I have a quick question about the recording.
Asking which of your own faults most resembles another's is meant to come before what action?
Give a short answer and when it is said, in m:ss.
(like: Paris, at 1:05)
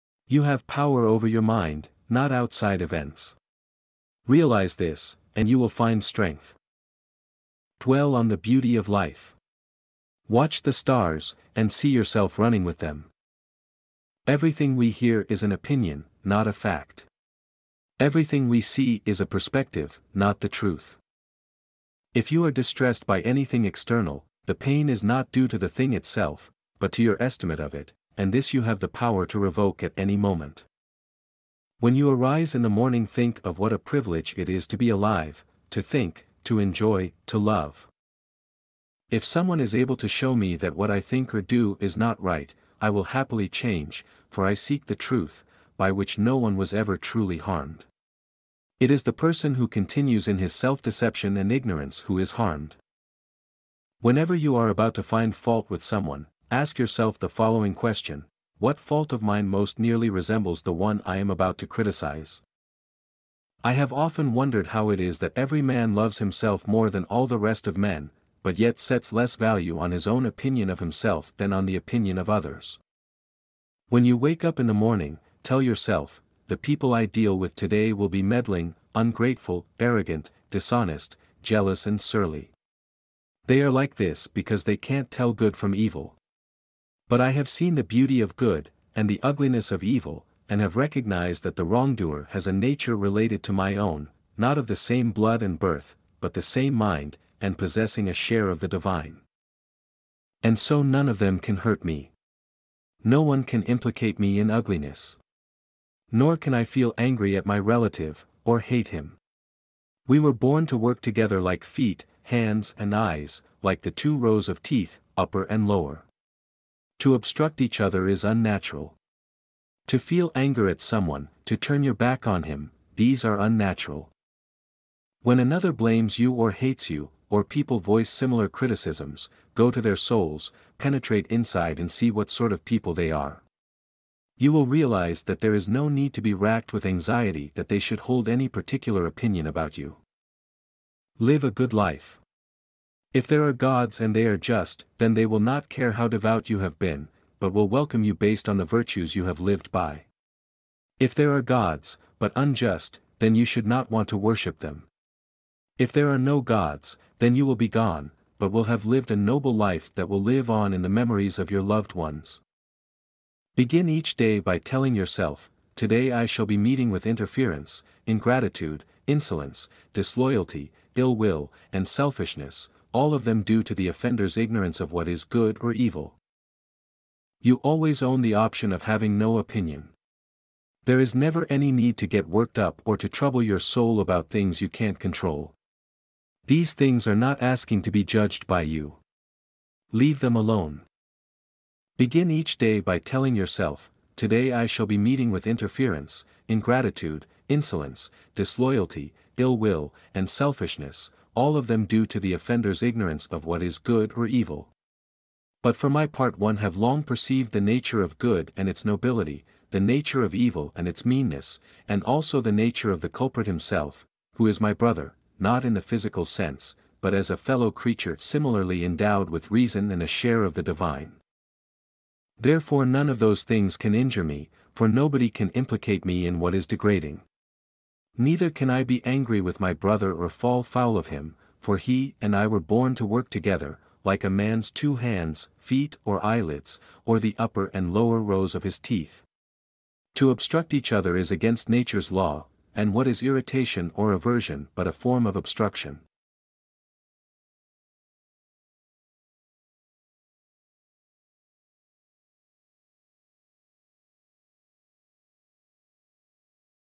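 find fault, at 0:55.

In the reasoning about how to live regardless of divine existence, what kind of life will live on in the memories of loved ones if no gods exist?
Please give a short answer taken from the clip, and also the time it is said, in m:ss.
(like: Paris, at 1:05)
a noble life, at 2:39.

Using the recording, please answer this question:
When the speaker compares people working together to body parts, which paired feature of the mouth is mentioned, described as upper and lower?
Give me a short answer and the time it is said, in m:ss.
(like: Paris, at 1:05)
two rows of teeth, at 1:53.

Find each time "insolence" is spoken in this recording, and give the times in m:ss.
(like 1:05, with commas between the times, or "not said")
2:49, 3:17.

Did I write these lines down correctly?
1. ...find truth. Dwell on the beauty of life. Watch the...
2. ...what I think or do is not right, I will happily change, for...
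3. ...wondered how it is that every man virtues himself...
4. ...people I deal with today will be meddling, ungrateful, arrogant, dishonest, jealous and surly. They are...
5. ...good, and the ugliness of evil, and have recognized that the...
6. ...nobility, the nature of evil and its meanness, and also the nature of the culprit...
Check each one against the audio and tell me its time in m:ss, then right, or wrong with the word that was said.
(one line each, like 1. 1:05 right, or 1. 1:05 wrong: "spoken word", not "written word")
1. 0:05 wrong: "strength", not "truth"
2. 0:40 right
3. 1:04 wrong: "loves", not "virtues"
4. 1:16 right
5. 1:28 right
6. 3:28 right.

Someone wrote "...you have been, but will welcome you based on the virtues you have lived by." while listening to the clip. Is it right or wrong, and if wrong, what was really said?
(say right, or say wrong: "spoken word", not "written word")
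right.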